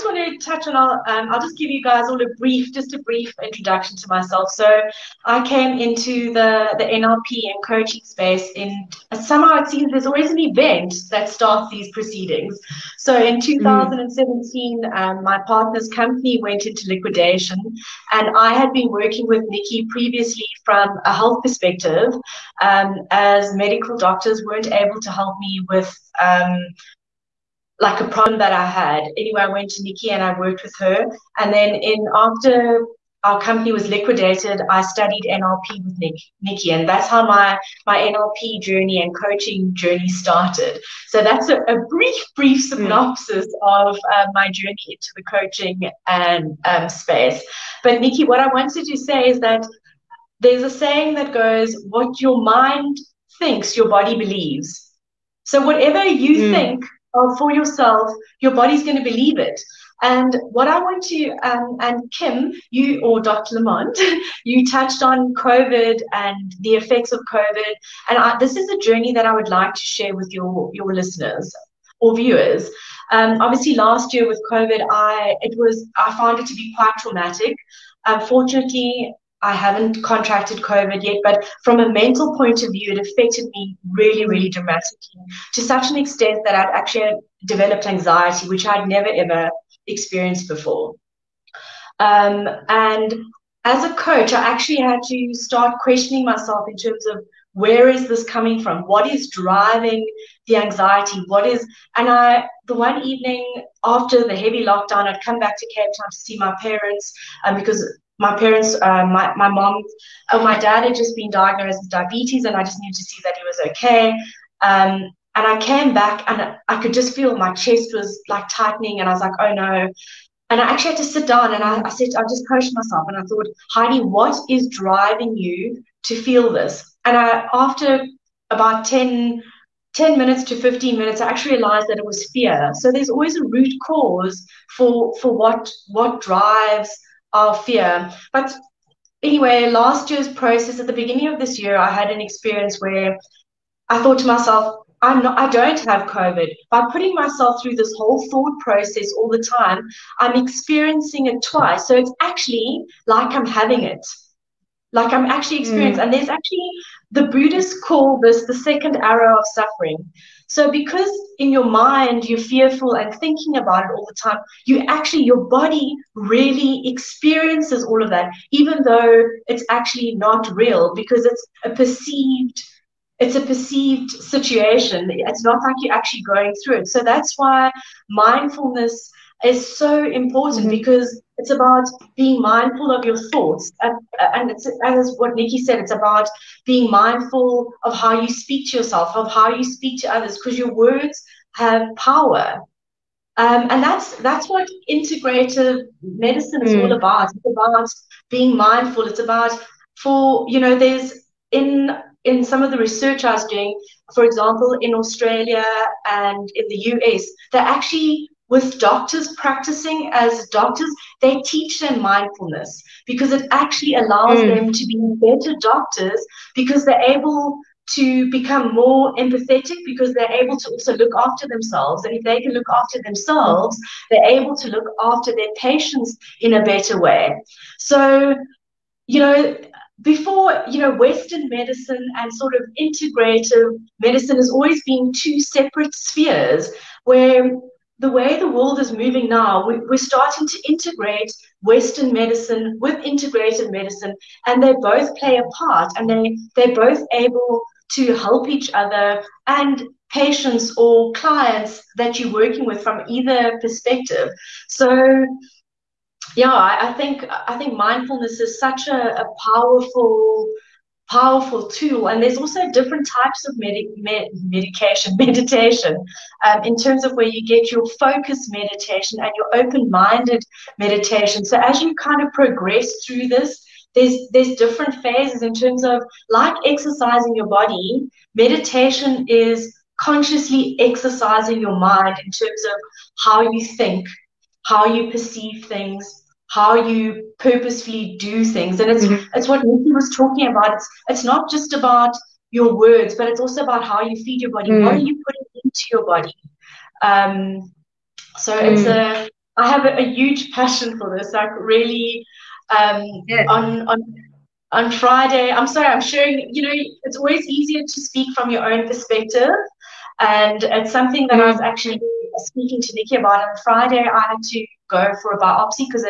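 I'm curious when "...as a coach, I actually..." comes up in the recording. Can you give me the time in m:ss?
1:33.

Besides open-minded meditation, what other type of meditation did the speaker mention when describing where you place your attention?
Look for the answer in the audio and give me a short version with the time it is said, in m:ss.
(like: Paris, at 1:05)
focus meditation, at 4:27.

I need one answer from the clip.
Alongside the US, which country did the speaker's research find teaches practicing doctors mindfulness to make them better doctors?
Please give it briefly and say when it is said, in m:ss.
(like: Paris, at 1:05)
Australia, at 3:24.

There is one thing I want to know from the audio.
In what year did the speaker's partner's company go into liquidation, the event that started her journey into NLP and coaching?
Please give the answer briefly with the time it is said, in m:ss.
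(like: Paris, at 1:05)
2017, at 0:13.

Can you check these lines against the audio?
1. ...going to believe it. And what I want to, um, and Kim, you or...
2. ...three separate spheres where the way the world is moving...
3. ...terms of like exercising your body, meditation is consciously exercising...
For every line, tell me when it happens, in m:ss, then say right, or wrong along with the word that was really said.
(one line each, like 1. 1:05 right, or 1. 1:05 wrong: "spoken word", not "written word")
1. 0:58 right
2. 3:55 wrong: "two", not "three"
3. 4:35 right.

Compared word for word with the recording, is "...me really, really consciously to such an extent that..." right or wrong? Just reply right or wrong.
wrong.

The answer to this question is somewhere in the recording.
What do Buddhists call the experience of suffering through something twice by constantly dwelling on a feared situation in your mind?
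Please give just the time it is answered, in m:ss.
2:38.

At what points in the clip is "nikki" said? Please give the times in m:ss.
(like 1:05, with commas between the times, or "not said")
0:19, 0:29, 0:36, 0:47, 3:05, 4:49, 5:12.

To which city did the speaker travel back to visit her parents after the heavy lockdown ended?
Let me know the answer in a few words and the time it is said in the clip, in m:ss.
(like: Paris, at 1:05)
Cape Town, at 1:45.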